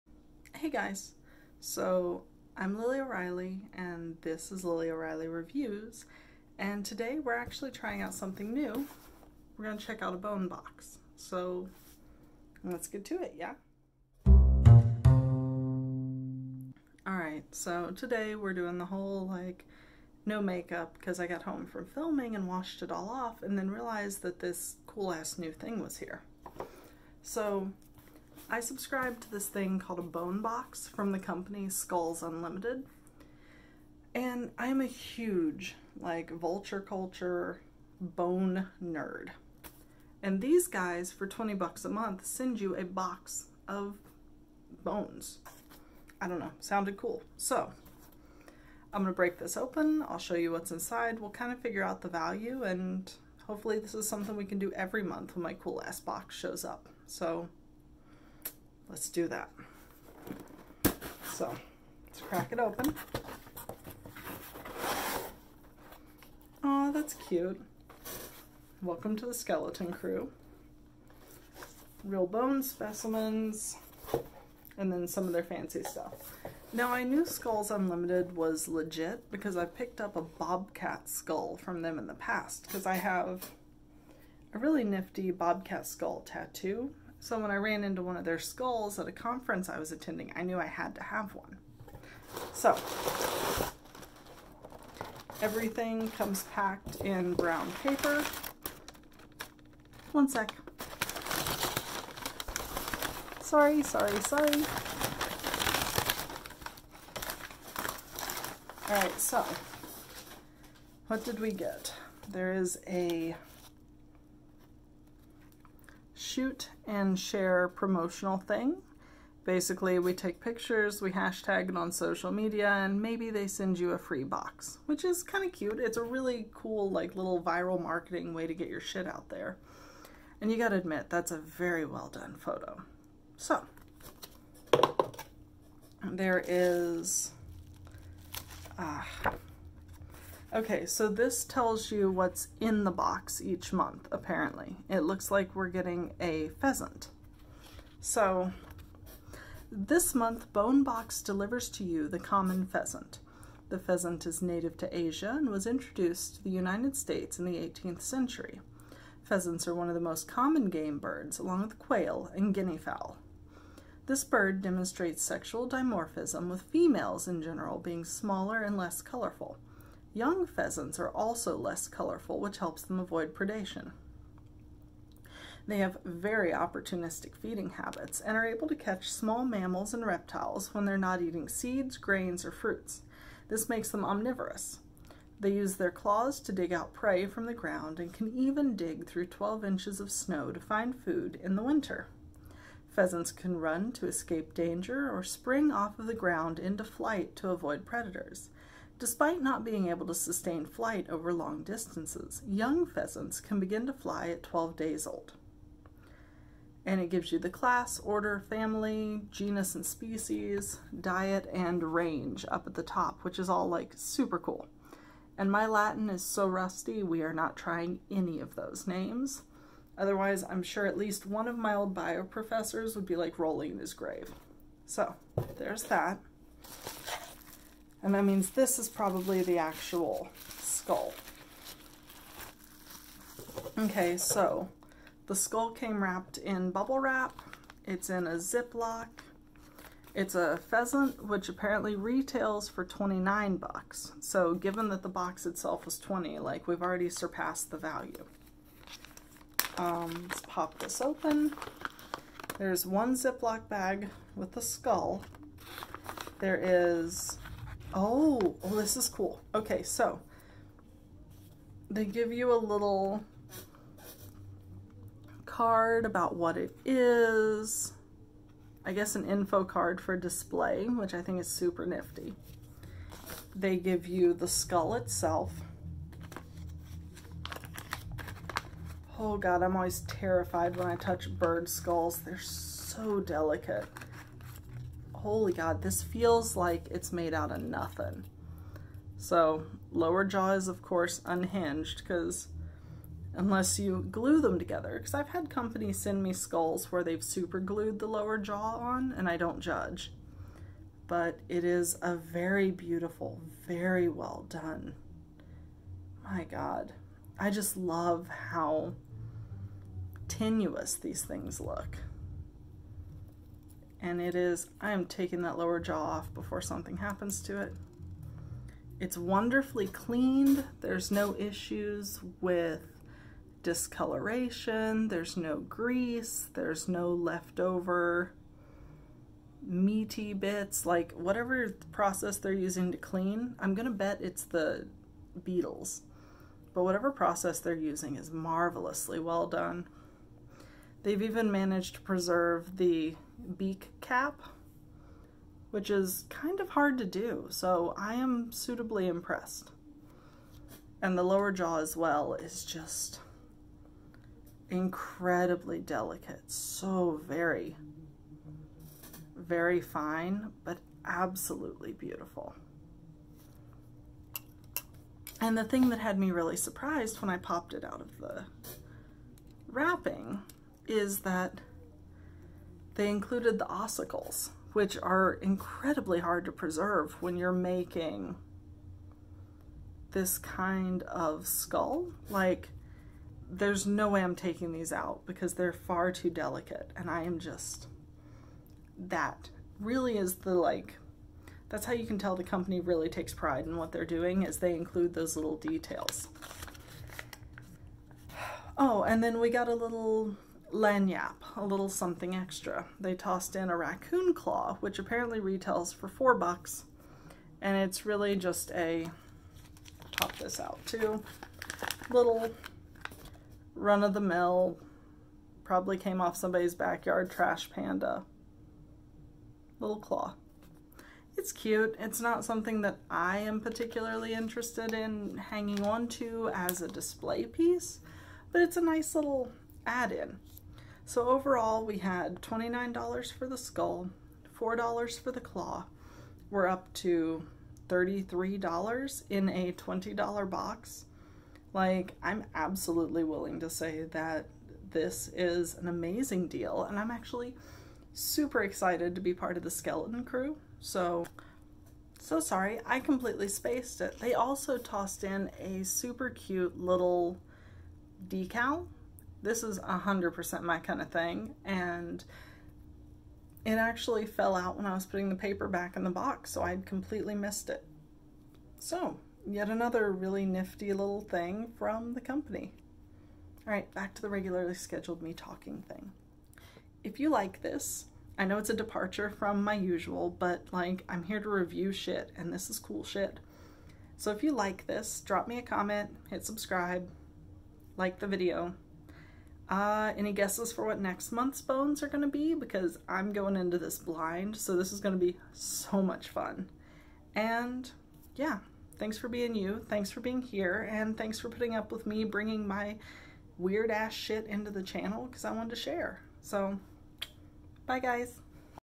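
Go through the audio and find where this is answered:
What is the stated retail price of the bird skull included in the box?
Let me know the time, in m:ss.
4:02.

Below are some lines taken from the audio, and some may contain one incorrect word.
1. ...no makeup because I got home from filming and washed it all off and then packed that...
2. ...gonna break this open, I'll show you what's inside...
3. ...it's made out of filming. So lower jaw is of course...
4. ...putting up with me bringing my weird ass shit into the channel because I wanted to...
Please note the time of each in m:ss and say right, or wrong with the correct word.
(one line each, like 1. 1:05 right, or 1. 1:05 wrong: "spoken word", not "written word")
1. 0:20 wrong: "realized", not "packed"
2. 0:49 right
3. 4:46 wrong: "nothing", not "filming"
4. 8:21 right.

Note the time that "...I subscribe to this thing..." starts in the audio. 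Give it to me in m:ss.
0:28.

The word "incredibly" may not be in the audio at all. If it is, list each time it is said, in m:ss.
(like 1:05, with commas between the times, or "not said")
5:54, 6:15.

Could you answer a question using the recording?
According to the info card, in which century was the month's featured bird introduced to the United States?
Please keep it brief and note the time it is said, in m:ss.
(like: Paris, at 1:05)
18th century, at 2:37.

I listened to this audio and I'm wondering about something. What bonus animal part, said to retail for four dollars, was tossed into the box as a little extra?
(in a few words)
Raccoon claw.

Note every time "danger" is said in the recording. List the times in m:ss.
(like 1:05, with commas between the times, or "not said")
3:14.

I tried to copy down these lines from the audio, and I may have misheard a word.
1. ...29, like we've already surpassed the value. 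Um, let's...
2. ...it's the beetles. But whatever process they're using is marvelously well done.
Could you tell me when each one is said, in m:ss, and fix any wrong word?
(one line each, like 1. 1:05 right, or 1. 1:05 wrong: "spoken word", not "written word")
1. 4:05 wrong: "20", not "29"
2. 5:34 right.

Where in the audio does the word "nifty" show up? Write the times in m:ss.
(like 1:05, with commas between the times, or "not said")
1:24, 4:31, 7:50.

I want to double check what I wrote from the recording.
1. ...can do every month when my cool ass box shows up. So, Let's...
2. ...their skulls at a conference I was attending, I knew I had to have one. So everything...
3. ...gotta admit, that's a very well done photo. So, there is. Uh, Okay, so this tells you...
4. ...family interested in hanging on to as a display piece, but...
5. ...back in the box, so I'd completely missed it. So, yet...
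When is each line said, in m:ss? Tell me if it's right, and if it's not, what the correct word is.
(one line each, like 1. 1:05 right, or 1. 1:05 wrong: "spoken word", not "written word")
1. 0:54 right
2. 1:28 right
3. 2:10 right
4. 7:03 wrong: "particularly", not "family"
5. 7:45 right.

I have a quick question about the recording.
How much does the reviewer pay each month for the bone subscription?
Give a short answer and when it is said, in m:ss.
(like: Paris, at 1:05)
$20, at 0:41.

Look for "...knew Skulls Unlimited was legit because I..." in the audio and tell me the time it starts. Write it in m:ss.
1:17.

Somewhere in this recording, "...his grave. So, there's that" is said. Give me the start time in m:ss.
3:43.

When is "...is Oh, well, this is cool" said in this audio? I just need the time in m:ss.
4:16.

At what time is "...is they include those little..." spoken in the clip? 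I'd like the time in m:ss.
6:34.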